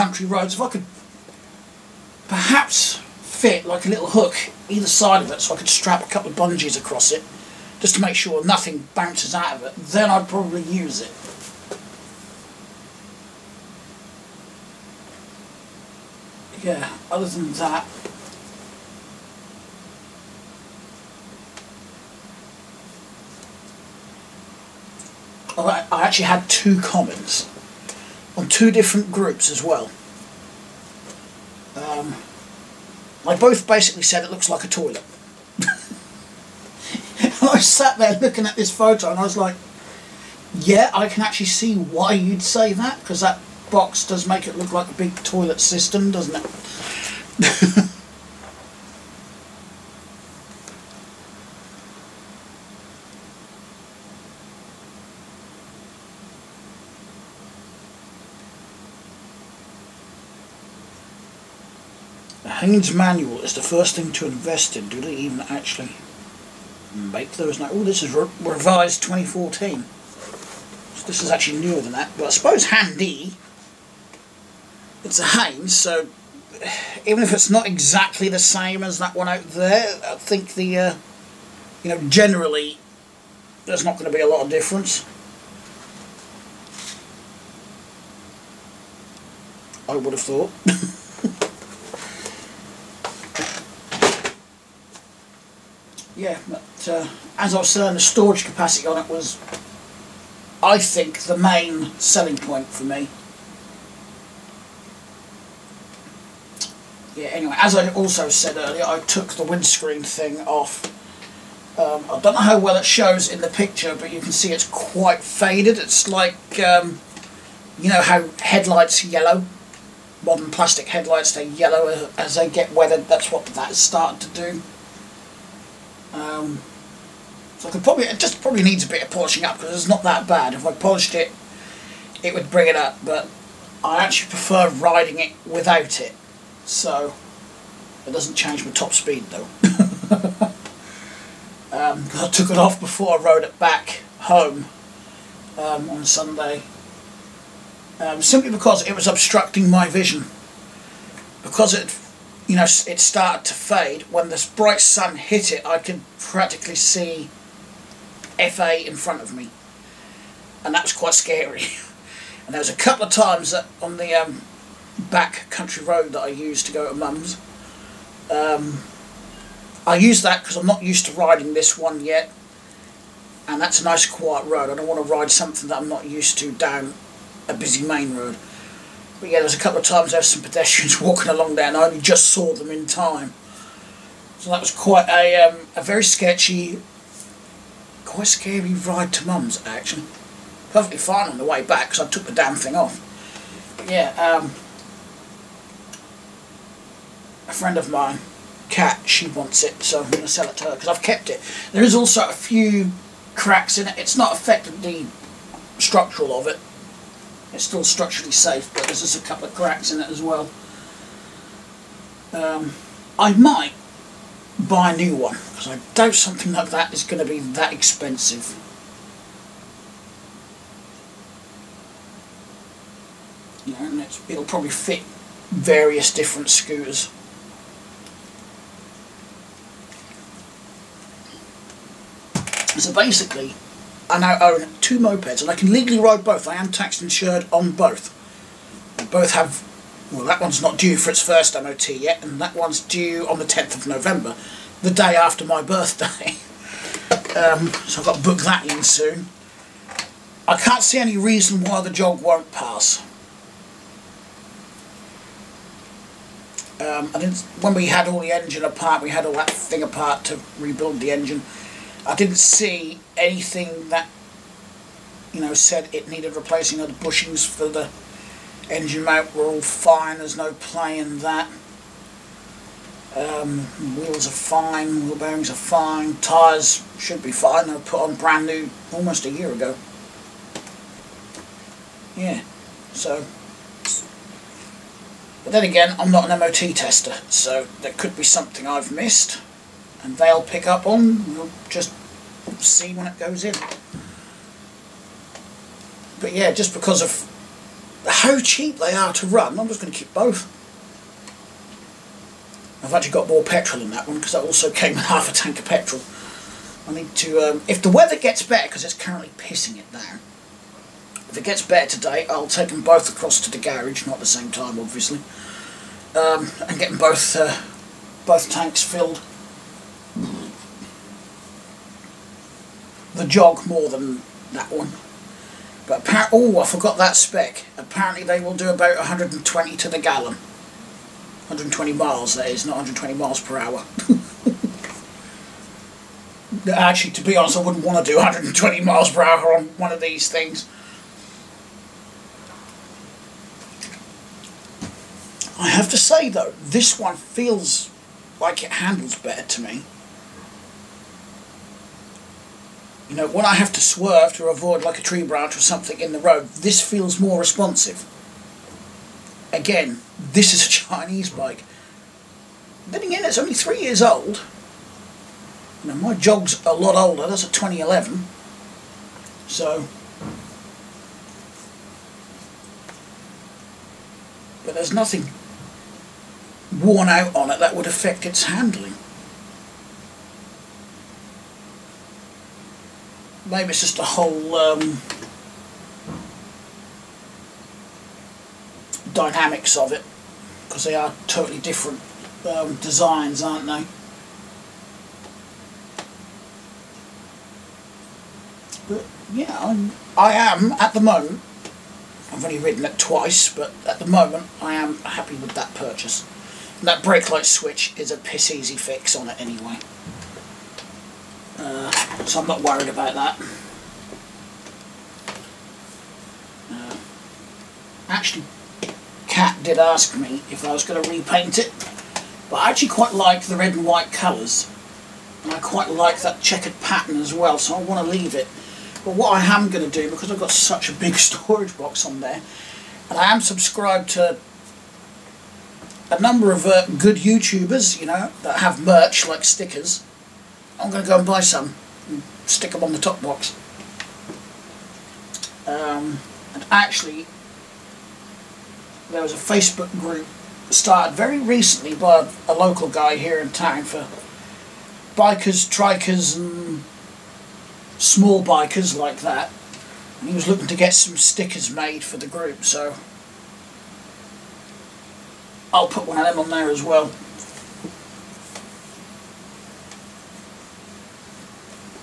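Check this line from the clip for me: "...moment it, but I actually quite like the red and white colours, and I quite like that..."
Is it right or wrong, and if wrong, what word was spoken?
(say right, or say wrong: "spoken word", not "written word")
wrong: "repaint", not "moment".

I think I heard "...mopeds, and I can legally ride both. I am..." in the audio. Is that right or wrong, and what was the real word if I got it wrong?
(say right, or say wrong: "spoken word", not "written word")
right.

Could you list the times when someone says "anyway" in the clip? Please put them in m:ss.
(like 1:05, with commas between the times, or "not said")
1:47, 6:49.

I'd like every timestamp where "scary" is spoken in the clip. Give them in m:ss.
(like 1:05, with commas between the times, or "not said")
2:41, 3:08.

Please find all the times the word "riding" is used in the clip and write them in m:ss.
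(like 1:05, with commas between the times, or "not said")
2:14, 2:51.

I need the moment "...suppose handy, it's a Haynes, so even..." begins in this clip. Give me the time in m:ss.
1:12.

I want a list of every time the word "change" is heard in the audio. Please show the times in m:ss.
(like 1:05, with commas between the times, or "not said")
2:18.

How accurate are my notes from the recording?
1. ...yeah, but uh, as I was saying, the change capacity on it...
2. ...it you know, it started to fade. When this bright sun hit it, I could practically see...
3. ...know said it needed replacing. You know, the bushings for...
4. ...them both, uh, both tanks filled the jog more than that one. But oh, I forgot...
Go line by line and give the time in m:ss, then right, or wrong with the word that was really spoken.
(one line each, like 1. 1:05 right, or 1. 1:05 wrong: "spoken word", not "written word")
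1. 1:36 wrong: "storage", not "change"
2. 2:31 right
3. 4:25 right
4. 5:16 right.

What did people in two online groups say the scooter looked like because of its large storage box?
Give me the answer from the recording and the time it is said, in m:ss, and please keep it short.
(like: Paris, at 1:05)
A toilet, at 0:34.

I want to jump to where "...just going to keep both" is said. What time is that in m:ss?
4:59.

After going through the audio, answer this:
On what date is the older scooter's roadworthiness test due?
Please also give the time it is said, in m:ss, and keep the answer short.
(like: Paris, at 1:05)
10th of November, at 4:03.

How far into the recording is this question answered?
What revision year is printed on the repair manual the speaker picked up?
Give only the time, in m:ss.
1:09.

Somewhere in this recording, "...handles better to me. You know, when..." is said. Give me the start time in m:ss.
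5:48.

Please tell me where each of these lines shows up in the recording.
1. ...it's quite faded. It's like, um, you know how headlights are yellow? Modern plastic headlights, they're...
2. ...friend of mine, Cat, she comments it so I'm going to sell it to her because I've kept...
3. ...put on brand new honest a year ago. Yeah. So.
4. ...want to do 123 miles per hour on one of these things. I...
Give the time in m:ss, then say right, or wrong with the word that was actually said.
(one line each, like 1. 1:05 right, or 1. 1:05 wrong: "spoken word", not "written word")
1. 1:54 right
2. 3:17 wrong: "wants", not "comments"
3. 4:37 wrong: "almost", not "honest"
4. 5:37 wrong: "120", not "123".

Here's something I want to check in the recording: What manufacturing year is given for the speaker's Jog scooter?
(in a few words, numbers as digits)
2011.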